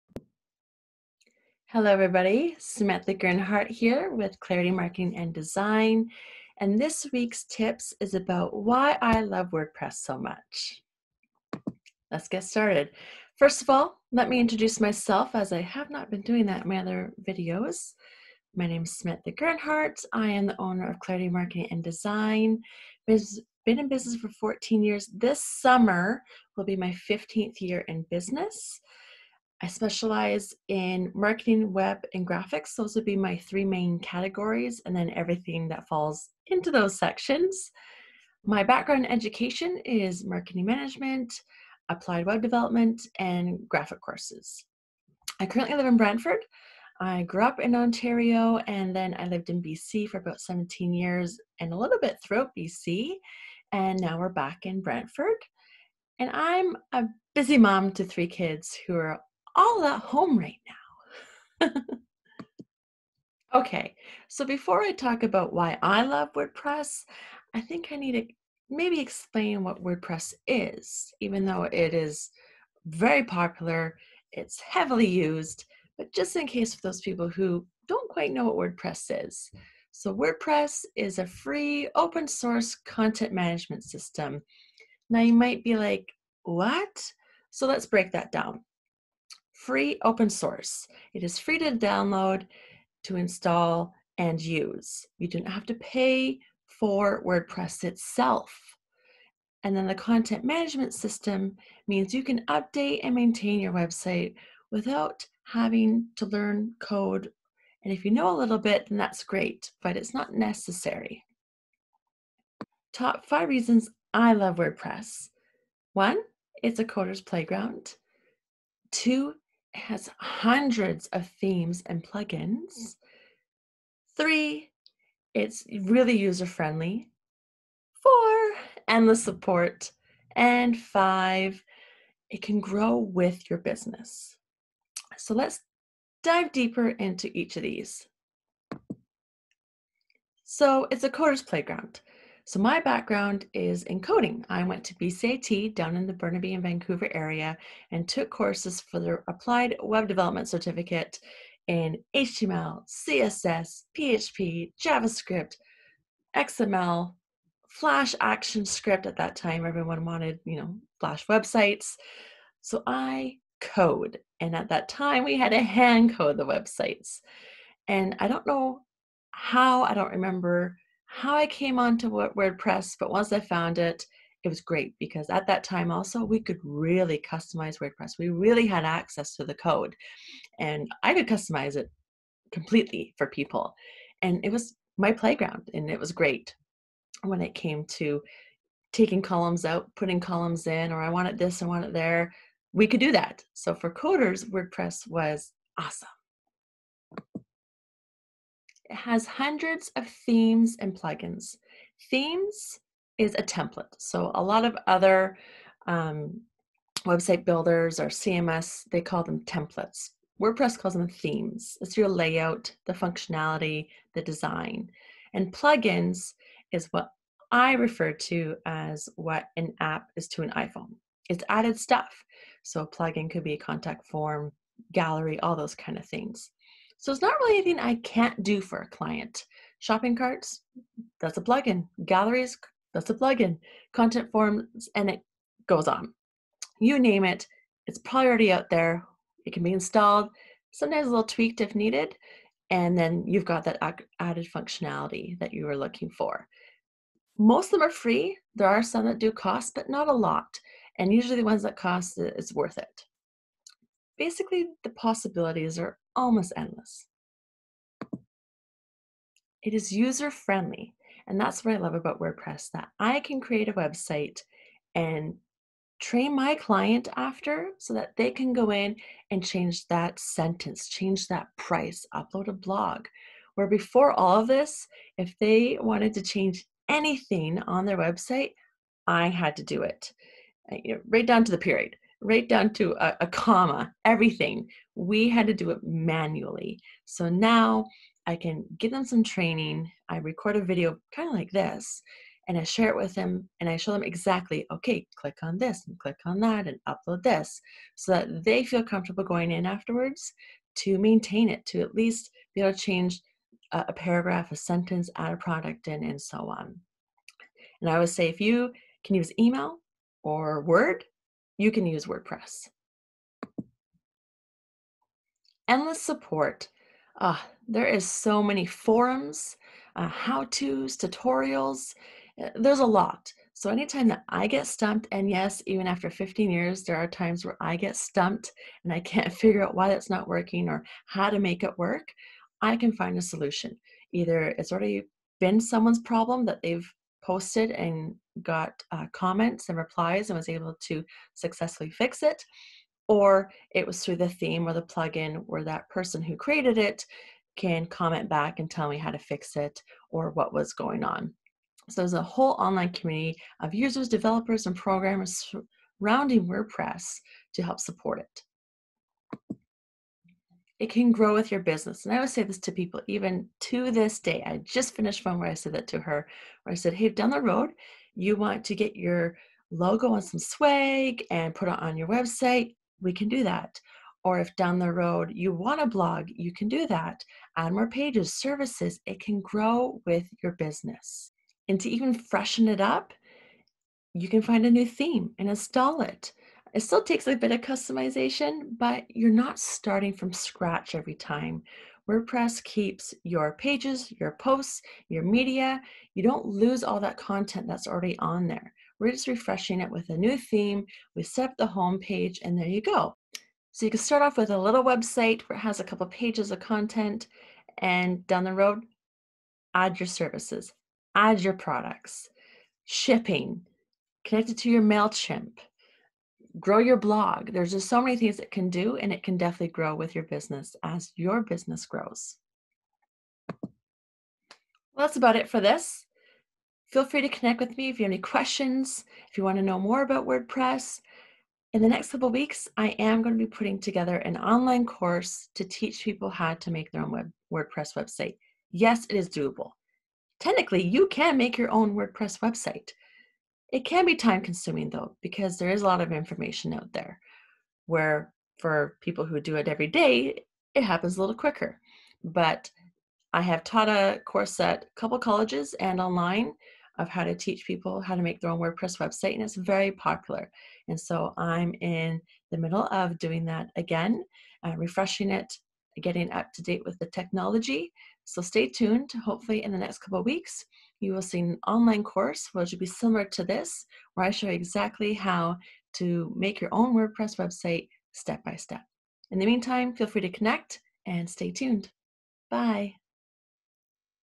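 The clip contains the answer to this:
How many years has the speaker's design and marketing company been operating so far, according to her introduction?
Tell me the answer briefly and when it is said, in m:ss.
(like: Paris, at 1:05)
14, at 0:24.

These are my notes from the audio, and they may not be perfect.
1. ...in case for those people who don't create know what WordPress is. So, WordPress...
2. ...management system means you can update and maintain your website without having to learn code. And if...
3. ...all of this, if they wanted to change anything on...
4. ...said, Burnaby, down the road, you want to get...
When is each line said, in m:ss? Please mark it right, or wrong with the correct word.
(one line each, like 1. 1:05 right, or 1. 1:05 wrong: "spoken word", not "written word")
1. 1:16 wrong: "quite", not "create"
2. 1:40 right
3. 4:34 right
4. 6:06 wrong: "Hey", not "Burnaby".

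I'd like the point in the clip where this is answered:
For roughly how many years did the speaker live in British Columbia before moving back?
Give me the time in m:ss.
0:50.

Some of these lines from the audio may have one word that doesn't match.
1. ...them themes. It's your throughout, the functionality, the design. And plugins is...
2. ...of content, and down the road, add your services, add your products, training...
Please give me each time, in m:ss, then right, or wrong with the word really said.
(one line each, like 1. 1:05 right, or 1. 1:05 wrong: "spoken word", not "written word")
1. 3:30 wrong: "layout", not "throughout"
2. 6:46 wrong: "shipping", not "training".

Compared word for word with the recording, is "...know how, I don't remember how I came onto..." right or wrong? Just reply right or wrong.
right.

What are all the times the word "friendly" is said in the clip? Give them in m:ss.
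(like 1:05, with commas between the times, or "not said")
2:06, 4:20.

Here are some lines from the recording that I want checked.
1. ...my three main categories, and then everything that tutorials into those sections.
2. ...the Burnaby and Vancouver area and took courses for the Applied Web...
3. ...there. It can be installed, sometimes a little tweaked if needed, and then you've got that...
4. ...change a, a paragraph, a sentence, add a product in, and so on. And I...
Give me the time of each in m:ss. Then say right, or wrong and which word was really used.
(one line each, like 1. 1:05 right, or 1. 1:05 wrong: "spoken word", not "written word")
1. 0:33 wrong: "falls", not "tutorials"
2. 2:26 right
3. 3:58 right
4. 5:02 right.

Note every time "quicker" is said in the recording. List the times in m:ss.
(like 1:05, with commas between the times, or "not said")
7:31.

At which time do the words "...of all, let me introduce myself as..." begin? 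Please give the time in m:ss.
0:13.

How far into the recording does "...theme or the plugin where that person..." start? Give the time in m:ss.
5:44.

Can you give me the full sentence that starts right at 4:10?
And usually the ones that cost, it's worth it.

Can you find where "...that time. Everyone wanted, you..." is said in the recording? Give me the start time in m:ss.
2:39.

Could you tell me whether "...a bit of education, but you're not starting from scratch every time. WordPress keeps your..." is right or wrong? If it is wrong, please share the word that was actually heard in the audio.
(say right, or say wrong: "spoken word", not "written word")
wrong: "customization", not "education".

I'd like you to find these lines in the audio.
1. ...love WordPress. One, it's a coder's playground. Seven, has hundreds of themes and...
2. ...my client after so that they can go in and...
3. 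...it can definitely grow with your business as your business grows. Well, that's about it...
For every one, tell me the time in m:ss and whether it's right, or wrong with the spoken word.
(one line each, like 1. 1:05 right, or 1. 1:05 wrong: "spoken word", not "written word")
1. 1:54 wrong: "Two", not "Seven"
2. 4:26 right
3. 6:59 right.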